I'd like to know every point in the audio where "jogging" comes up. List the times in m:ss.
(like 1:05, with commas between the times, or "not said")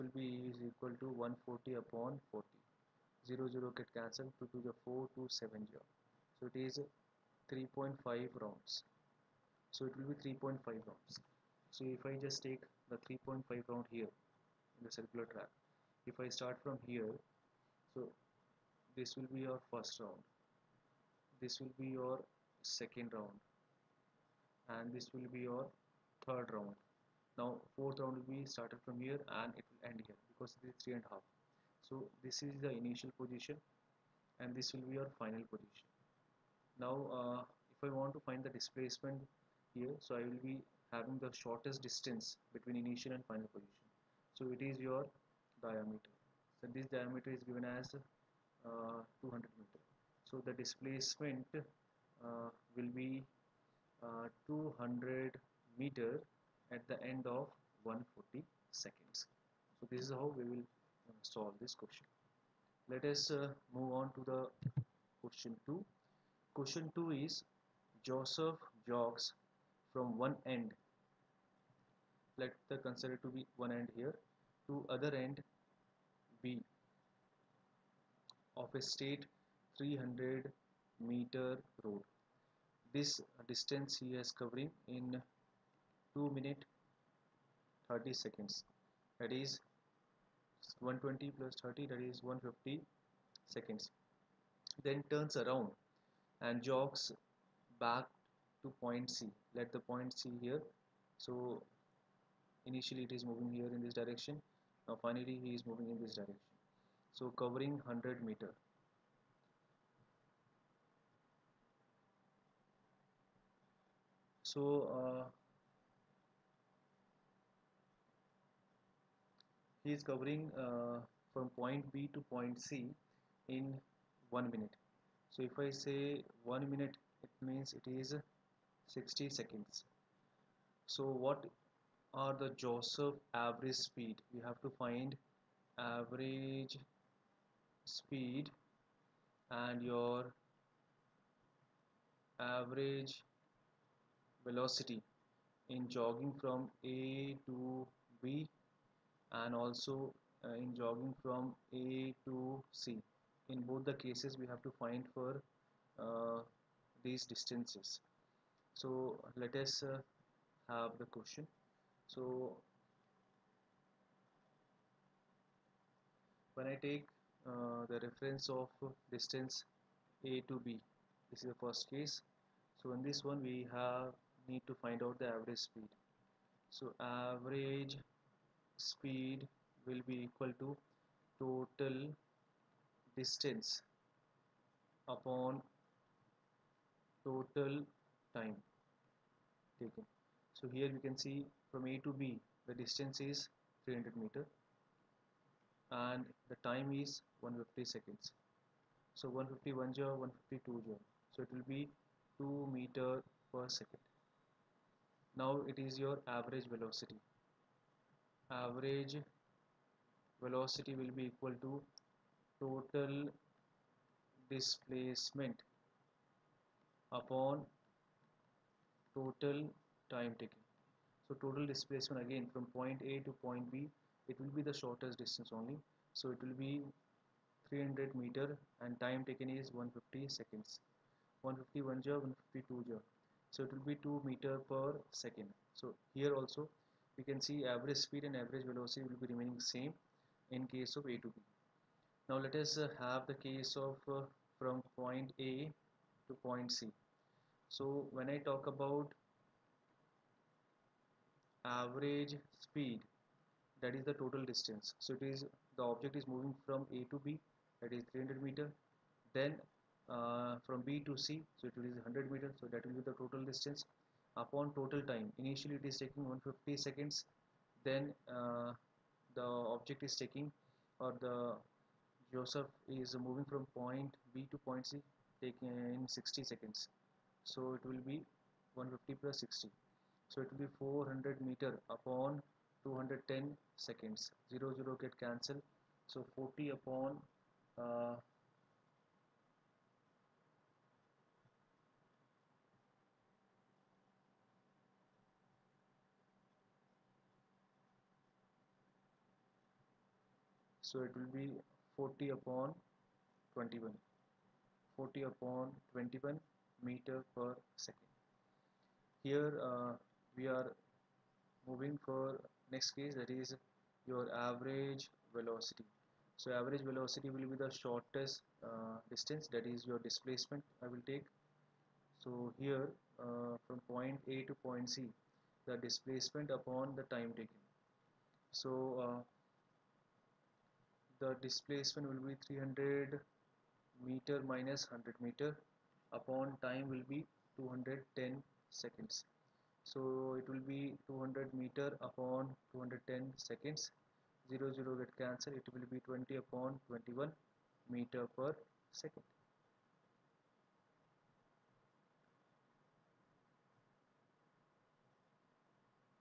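2:25, 2:30.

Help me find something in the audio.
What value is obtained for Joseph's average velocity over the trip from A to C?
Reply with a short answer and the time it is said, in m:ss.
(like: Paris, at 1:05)
20/21 m/s, at 5:46.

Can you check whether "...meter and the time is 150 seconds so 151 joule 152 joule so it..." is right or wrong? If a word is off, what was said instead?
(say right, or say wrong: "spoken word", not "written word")
right.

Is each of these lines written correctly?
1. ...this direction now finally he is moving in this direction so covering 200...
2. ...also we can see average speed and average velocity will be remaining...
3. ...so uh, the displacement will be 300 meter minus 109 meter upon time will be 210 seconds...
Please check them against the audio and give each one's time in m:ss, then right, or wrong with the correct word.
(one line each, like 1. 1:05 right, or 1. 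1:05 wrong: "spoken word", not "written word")
1. 1:43 wrong: "100", not "200"
2. 3:56 right
3. 5:28 wrong: "100", not "109".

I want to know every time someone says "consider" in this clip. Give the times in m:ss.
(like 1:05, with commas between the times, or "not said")
1:12.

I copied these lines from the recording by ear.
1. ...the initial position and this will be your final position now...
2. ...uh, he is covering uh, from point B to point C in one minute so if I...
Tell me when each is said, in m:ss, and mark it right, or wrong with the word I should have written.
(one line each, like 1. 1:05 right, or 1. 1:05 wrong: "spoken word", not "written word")
1. 0:32 right
2. 1:54 right.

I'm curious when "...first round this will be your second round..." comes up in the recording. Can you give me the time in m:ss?
0:19.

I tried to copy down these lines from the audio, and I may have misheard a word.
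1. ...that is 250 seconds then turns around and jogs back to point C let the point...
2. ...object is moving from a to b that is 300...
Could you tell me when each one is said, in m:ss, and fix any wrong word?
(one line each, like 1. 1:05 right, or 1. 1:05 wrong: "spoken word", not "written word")
1. 1:31 wrong: "150", not "250"
2. 4:15 right.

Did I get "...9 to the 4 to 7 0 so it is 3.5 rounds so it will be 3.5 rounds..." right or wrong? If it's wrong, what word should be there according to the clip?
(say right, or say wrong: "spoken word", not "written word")
wrong: "2", not "9".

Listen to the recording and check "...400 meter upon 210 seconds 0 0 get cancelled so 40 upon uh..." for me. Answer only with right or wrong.
right.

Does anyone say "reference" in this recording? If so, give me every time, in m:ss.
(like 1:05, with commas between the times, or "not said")
2:47.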